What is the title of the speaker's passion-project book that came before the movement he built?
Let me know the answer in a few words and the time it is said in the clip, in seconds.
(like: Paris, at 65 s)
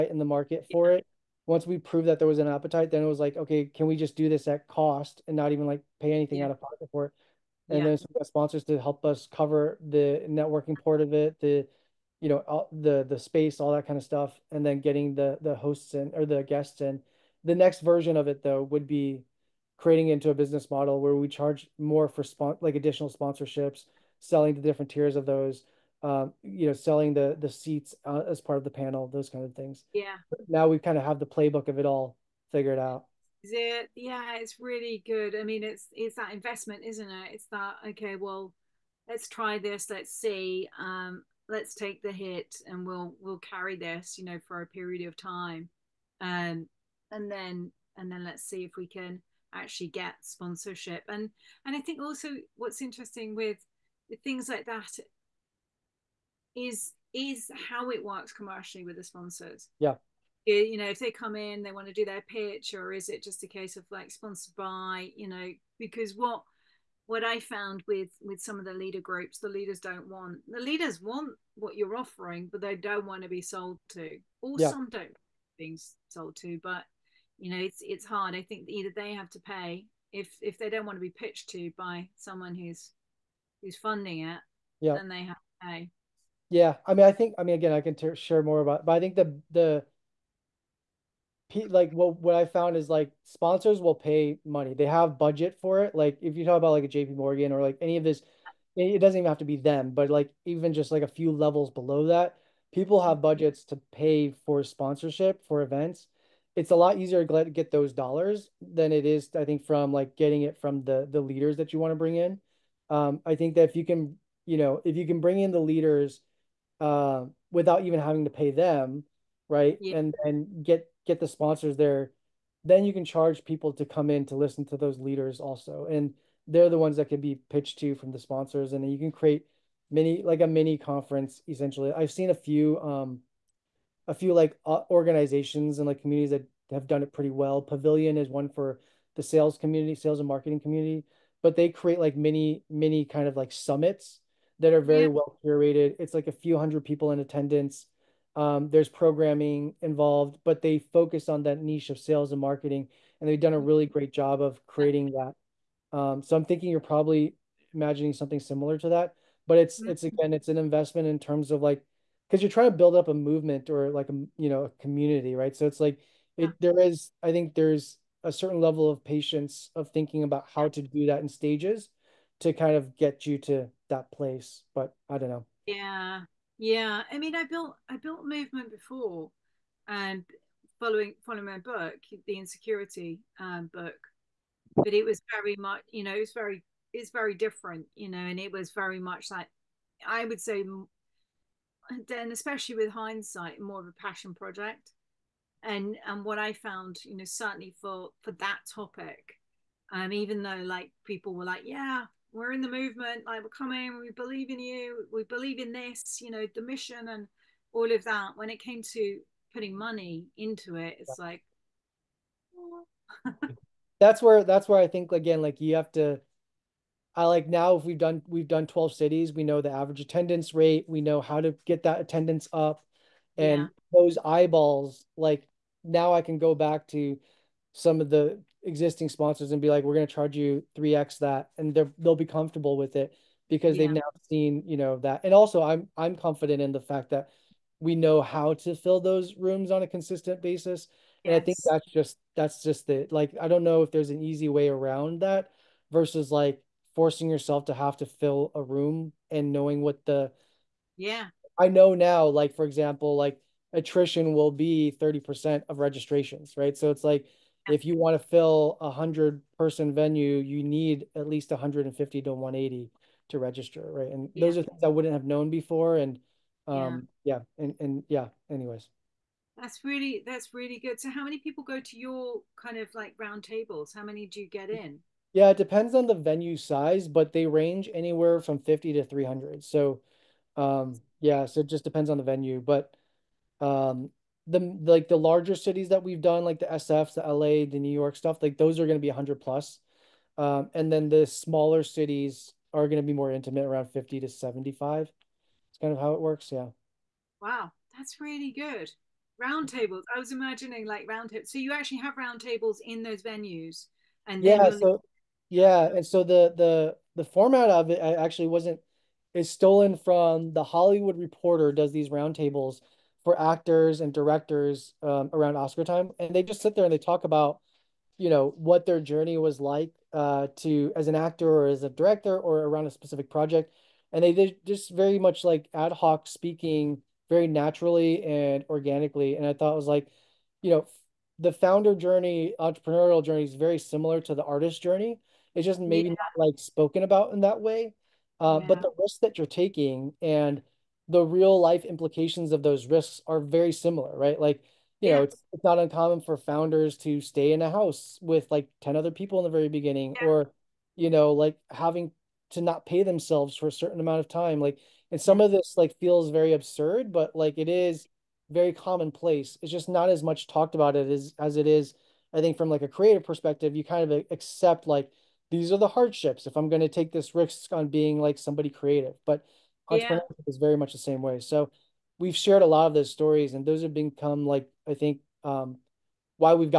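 IN Security, at 182 s.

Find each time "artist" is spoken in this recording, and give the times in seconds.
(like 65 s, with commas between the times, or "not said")
334 s.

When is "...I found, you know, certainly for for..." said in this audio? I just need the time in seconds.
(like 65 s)
196 s.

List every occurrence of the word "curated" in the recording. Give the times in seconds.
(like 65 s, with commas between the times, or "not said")
145 s.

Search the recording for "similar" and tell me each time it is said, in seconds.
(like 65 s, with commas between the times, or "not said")
158 s, 333 s, 343 s.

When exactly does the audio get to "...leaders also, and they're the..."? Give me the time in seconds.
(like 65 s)
124 s.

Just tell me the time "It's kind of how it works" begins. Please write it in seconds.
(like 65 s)
295 s.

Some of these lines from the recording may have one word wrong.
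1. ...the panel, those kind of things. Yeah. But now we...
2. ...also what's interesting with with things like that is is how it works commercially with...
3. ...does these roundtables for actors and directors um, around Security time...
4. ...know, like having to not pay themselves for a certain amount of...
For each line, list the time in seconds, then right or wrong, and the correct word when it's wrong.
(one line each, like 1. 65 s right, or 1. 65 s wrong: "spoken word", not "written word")
1. 28 s right
2. 52 s right
3. 311 s wrong: "Oscar", not "Security"
4. 351 s right.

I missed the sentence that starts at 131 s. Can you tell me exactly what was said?
I've seen a few um, a few like organizations and like communities that have done it pretty well.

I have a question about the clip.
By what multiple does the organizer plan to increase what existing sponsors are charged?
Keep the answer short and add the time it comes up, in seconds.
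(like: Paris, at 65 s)
3x, at 230 s.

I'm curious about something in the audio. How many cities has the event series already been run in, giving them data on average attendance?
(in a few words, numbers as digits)
12.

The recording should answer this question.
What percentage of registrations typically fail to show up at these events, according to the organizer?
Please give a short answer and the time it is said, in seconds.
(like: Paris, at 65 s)
30%, at 254 s.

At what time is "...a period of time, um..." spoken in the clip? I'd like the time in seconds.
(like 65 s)
44 s.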